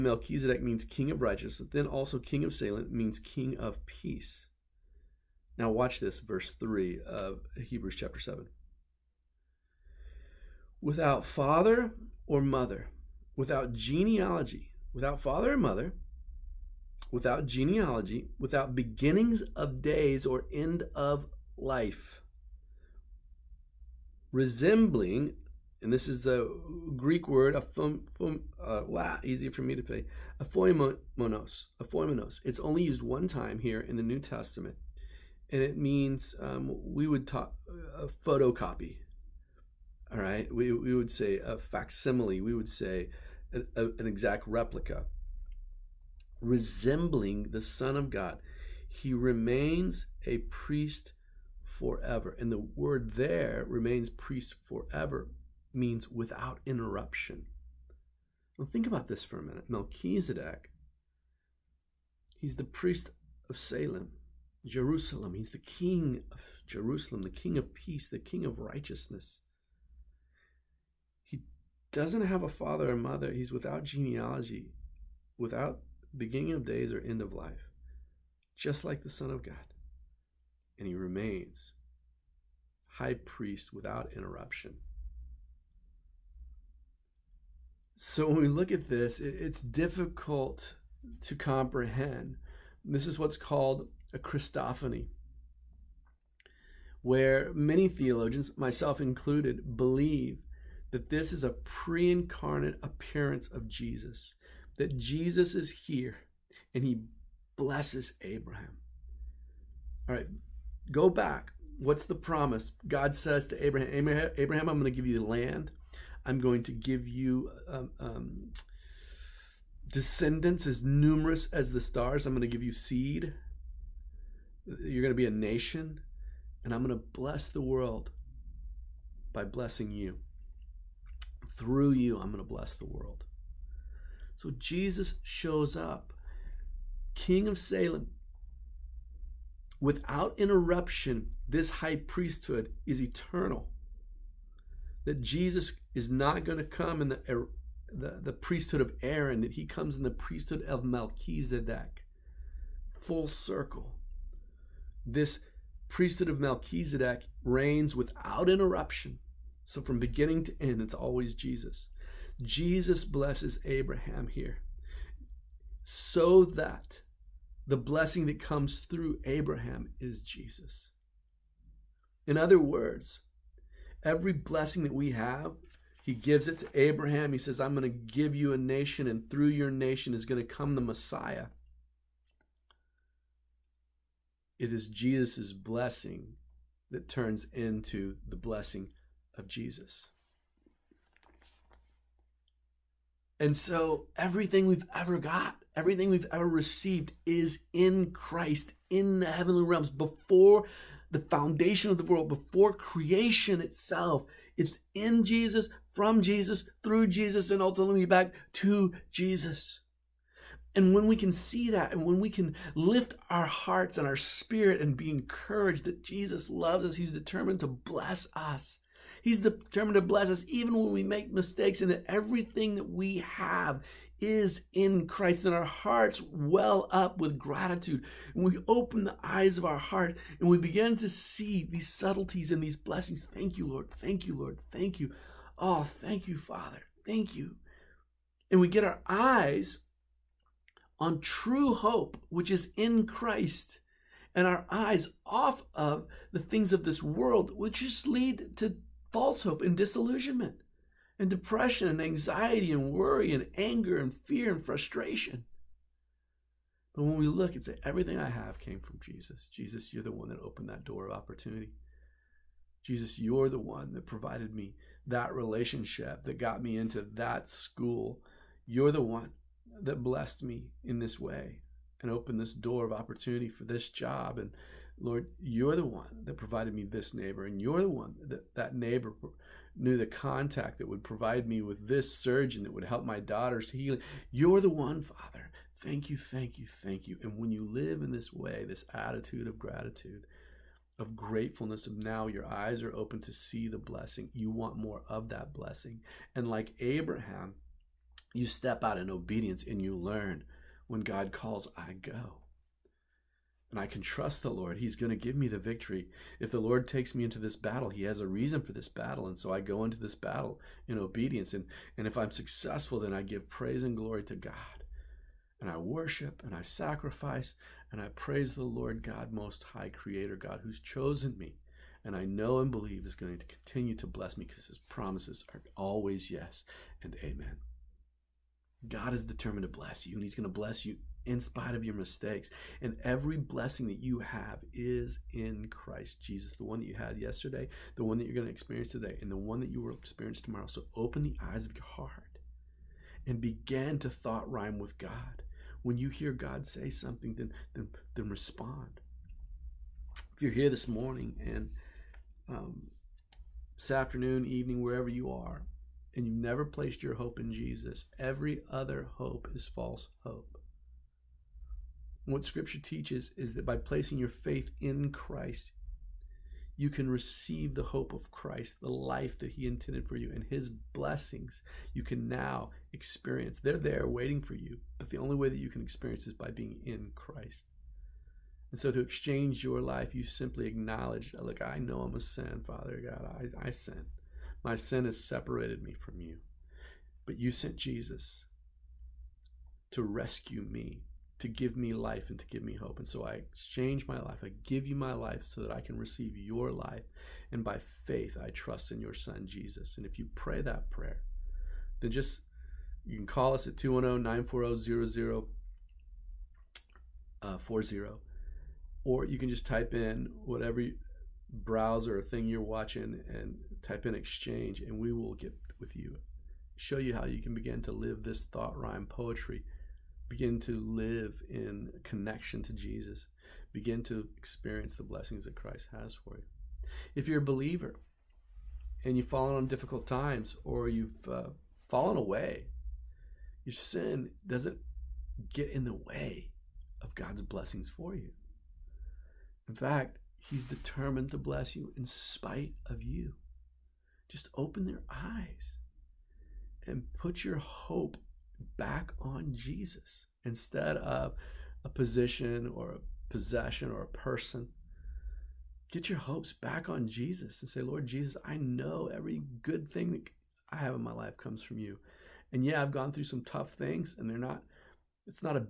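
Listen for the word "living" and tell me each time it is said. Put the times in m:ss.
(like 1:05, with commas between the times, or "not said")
not said.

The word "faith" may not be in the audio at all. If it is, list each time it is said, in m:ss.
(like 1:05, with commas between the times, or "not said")
6:04, 6:38.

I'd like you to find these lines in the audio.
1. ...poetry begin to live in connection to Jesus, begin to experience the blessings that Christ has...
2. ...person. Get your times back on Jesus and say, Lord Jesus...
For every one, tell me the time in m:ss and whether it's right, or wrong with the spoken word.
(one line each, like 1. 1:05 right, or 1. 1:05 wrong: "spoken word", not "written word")
1. 6:59 right
2. 7:34 wrong: "hopes", not "times".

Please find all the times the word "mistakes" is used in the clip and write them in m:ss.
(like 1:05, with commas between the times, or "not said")
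3:41, 5:31.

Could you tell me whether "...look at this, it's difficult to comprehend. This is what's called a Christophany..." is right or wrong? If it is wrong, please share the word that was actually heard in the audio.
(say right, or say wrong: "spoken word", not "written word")
right.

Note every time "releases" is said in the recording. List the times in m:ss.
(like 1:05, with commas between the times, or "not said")
not said.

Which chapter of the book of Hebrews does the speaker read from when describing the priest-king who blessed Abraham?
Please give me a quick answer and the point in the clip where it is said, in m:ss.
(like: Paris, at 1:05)
Chapter 7, at 0:07.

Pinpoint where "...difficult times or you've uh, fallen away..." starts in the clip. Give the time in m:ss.
7:09.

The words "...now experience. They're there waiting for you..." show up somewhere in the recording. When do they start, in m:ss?
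6:12.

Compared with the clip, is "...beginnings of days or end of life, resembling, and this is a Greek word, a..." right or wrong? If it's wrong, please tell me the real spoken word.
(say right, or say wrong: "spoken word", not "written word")
right.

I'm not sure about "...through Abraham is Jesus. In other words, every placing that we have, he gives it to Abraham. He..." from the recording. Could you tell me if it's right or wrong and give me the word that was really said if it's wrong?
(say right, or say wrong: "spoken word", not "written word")
wrong: "blessing", not "placing".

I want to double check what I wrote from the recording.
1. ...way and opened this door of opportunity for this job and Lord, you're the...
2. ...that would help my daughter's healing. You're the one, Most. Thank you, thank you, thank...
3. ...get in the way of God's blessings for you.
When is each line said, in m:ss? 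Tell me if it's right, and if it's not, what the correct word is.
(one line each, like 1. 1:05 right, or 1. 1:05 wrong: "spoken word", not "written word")
1. 4:31 right
2. 4:42 wrong: "Father", not "Most"
3. 7:15 right.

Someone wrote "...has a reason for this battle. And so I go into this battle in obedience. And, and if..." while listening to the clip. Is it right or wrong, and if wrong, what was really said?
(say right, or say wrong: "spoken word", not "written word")
right.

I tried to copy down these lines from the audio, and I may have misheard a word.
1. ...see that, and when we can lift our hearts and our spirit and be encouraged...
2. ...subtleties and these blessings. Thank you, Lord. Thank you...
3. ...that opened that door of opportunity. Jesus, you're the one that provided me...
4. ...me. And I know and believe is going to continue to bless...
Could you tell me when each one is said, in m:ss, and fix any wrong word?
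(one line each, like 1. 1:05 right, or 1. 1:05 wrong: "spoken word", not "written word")
1. 3:31 right
2. 3:51 right
3. 4:20 right
4. 5:21 right.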